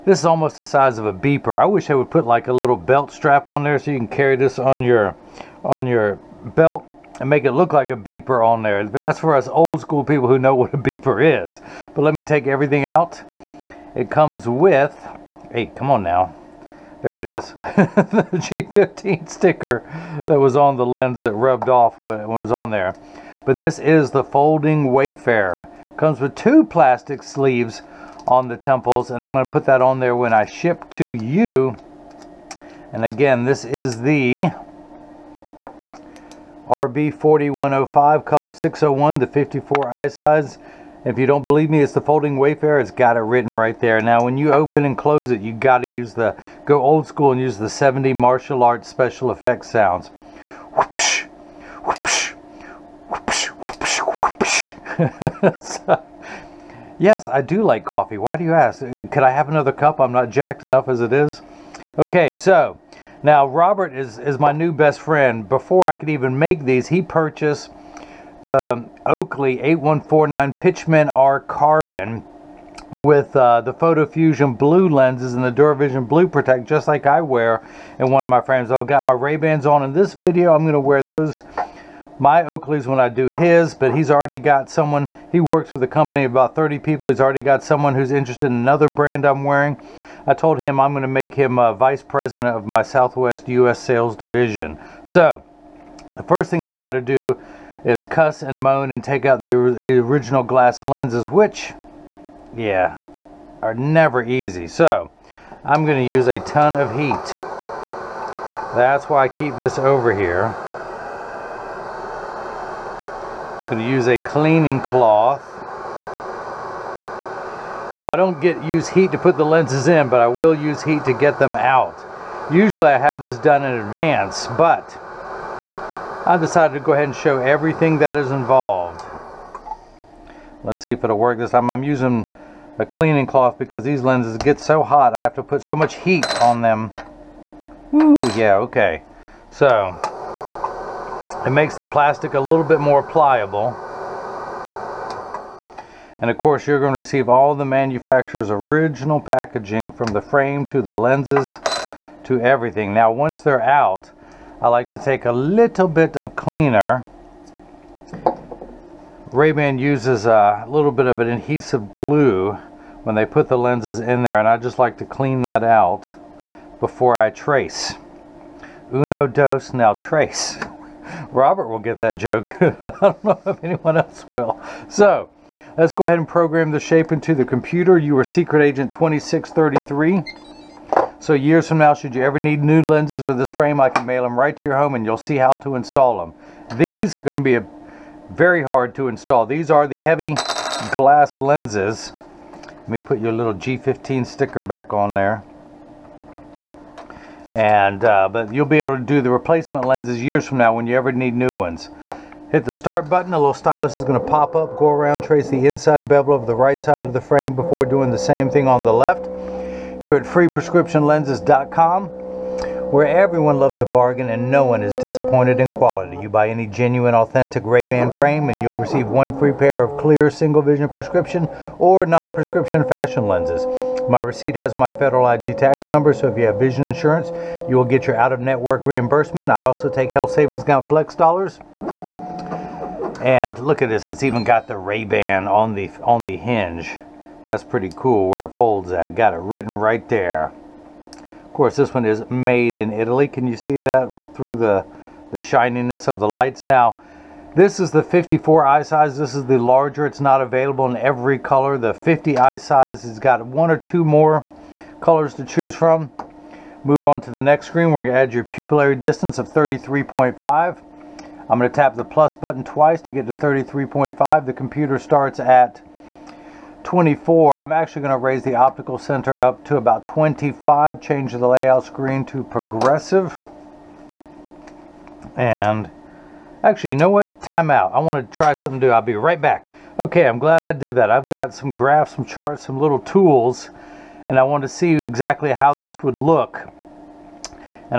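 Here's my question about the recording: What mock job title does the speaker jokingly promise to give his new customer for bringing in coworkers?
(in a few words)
vice president.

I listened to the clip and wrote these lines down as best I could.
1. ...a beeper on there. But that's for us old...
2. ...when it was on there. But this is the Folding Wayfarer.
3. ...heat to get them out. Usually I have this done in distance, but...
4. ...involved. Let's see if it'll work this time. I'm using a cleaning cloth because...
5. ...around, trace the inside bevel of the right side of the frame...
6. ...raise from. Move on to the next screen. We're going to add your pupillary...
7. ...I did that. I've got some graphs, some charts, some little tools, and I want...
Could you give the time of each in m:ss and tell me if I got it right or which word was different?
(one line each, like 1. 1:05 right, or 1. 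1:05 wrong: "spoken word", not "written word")
1. 0:07 right
2. 0:22 right
3. 2:00 wrong: "advance", not "distance"
4. 2:08 right
5. 3:24 right
6. 4:15 wrong: "choose", not "raise"
7. 4:40 right.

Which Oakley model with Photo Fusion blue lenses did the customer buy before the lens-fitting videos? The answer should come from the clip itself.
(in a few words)
8149 Pitchman R Carbon.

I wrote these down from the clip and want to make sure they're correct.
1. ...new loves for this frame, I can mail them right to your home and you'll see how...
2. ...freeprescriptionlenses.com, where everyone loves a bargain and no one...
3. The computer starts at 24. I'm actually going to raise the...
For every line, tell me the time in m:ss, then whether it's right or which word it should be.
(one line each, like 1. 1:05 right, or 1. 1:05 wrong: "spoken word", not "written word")
1. 3:02 wrong: "lenses", not "loves"
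2. 3:30 right
3. 4:24 right.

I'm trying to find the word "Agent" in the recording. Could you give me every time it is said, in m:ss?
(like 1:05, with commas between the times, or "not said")
2:58.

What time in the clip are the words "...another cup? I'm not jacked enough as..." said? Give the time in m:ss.
0:59.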